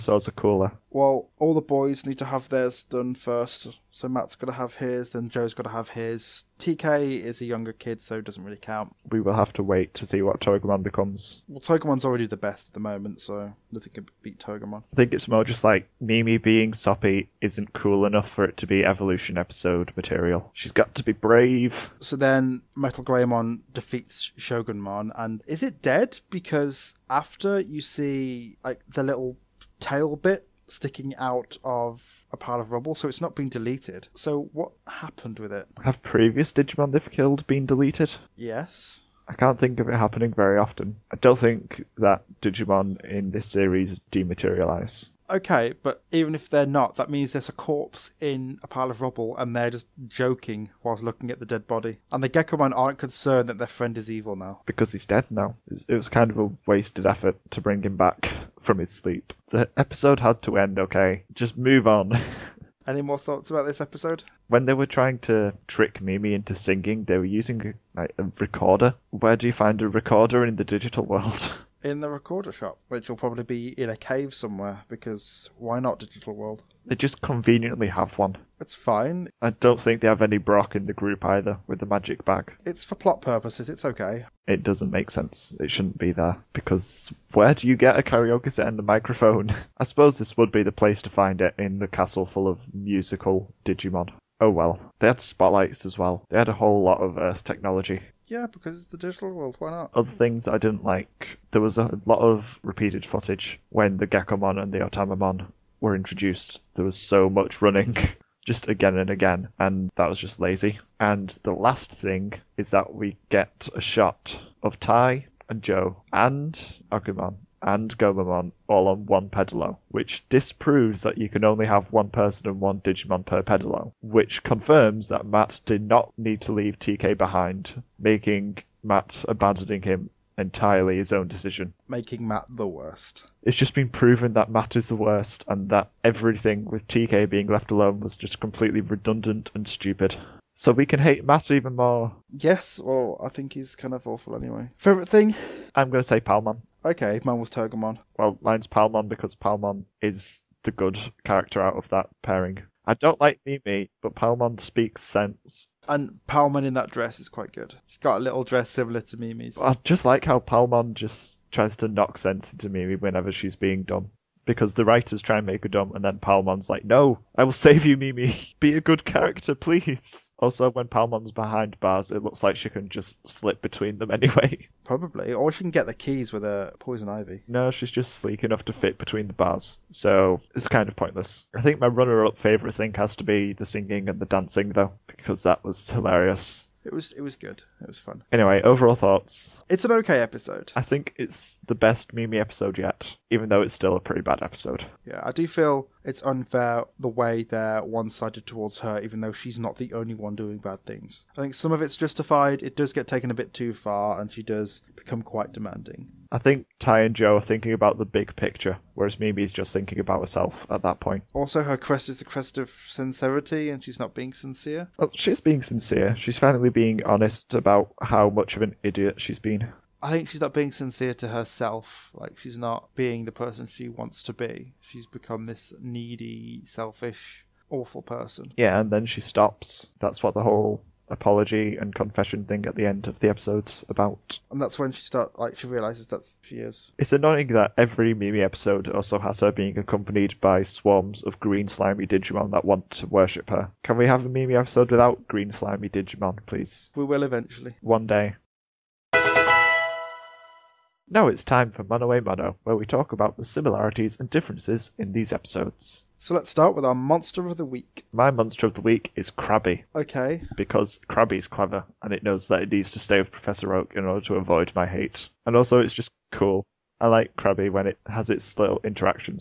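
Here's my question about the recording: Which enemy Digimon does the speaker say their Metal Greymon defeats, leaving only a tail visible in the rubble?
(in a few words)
Shogunmon.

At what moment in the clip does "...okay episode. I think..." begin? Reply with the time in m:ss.
3:09.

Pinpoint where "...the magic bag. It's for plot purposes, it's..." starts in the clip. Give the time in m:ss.
1:21.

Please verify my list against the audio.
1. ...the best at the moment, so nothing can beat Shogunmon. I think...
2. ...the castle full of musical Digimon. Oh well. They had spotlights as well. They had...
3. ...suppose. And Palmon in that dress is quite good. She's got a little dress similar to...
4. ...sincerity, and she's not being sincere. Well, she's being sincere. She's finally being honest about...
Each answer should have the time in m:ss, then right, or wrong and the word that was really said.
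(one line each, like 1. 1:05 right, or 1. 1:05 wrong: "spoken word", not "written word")
1. 0:12 wrong: "Togemon", not "Shogunmon"
2. 1:31 right
3. 2:35 wrong: "sense", not "suppose"
4. 3:32 right.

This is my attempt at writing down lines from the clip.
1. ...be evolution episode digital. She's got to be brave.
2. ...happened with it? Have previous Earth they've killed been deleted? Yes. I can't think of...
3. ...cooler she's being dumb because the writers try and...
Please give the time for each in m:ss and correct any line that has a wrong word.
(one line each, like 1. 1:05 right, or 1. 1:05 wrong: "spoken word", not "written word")
1. 0:18 wrong: "material", not "digital"
2. 0:34 wrong: "Digimon", not "Earth"
3. 2:42 wrong: "whenever", not "cooler".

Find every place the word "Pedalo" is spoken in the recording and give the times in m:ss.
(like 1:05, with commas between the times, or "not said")
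1:59, 2:03.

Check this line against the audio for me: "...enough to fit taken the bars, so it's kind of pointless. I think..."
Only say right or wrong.
wrong.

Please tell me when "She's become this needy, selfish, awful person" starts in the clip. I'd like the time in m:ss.
3:44.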